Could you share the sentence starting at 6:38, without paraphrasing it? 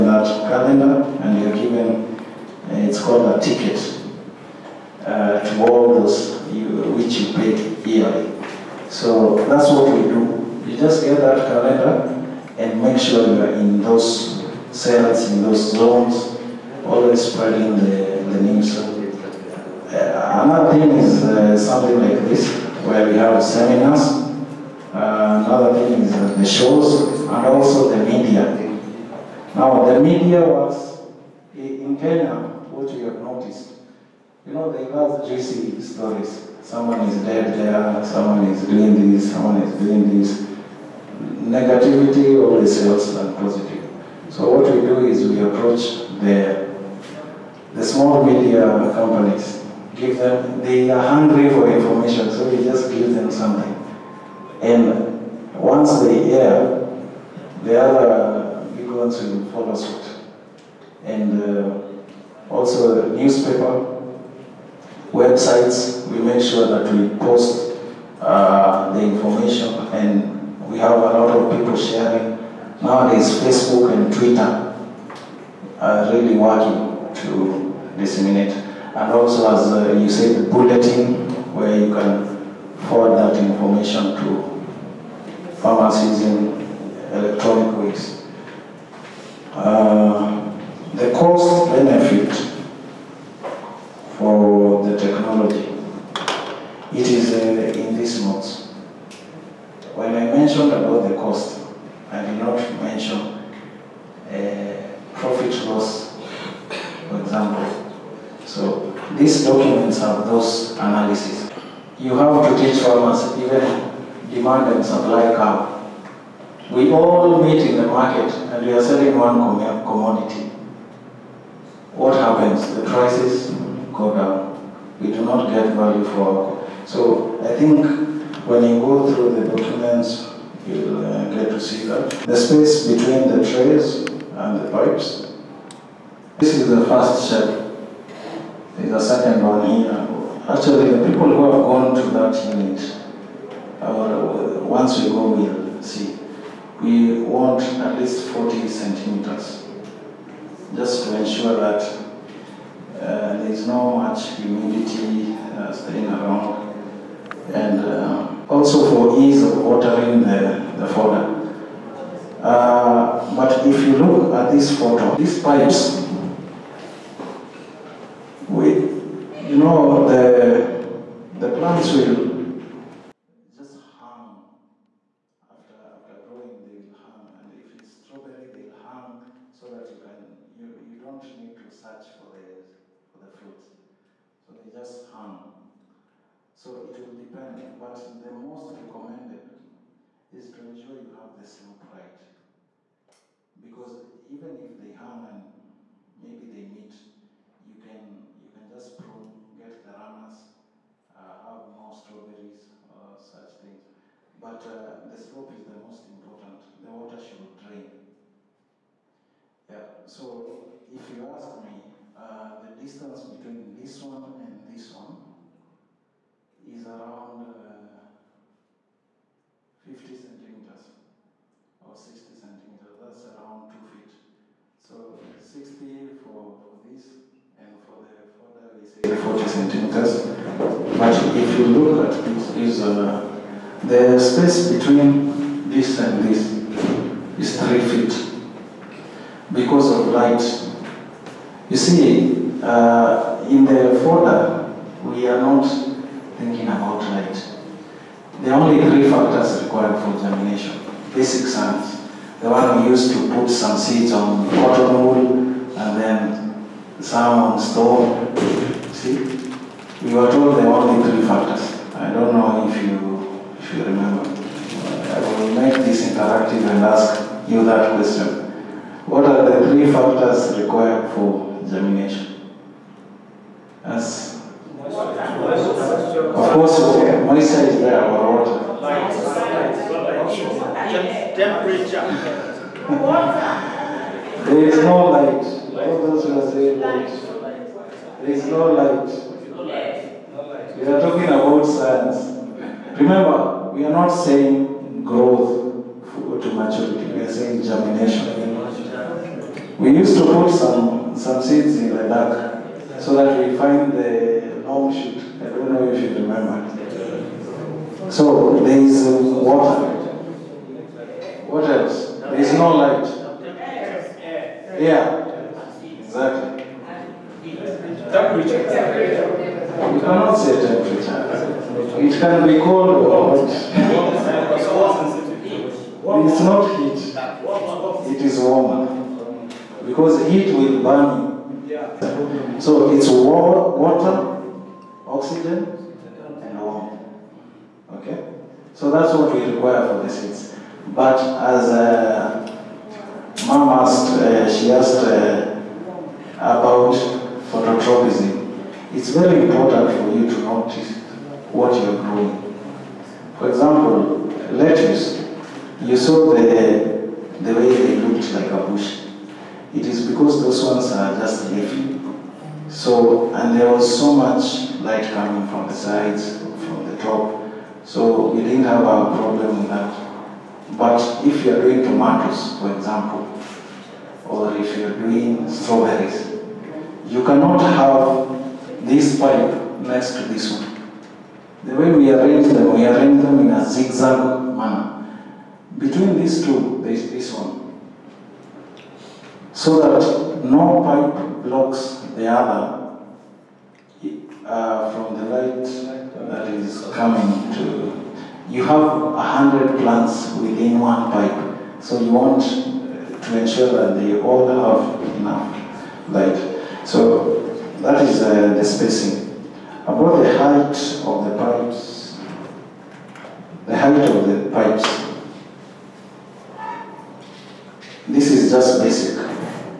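You have a hundred plants within one pipe, so you want to ensure that they all have enough light.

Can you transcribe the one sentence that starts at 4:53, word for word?
Remember, we are not saying growth go to maturity.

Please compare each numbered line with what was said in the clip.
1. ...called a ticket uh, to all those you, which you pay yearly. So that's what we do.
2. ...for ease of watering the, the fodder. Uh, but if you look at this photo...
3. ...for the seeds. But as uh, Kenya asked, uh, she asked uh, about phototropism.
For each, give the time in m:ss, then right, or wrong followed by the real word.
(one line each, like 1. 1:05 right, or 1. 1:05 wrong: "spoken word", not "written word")
1. 0:03 right
2. 2:38 right
3. 5:39 wrong: "Mom", not "Kenya".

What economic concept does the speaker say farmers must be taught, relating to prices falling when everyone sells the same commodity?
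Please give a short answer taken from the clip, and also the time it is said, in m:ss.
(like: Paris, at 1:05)
demand and supply curve, at 1:54.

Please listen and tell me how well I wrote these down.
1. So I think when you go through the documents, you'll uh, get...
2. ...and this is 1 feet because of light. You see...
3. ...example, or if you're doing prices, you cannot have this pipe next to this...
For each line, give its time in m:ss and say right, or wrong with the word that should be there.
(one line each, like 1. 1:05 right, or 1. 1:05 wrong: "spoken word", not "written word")
1. 2:06 right
2. 3:56 wrong: "3", not "1"
3. 6:12 wrong: "strawberries", not "prices".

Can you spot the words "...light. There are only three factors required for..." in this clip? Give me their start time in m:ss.
4:07.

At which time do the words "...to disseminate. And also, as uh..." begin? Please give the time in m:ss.
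1:17.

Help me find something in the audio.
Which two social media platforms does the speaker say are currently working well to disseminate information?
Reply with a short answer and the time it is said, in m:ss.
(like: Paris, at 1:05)
Facebook and Twitter, at 1:13.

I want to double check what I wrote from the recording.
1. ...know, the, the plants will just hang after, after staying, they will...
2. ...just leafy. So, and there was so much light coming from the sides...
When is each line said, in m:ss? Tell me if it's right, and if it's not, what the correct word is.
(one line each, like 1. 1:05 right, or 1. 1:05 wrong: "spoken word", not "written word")
1. 2:49 wrong: "growing", not "staying"
2. 6:01 right.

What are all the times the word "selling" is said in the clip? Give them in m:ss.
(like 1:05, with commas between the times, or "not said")
1:58.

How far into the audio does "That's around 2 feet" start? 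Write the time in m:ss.
3:42.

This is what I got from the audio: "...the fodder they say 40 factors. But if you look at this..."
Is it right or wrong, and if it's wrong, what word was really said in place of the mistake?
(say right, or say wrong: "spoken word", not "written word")
wrong: "centimeters", not "factors".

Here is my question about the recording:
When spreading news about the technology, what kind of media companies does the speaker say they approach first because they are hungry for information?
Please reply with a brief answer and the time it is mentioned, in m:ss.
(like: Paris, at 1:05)
small media companies, at 0:47.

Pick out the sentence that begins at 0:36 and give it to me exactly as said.
Someone is dead there, someone is doing this, someone is doing this.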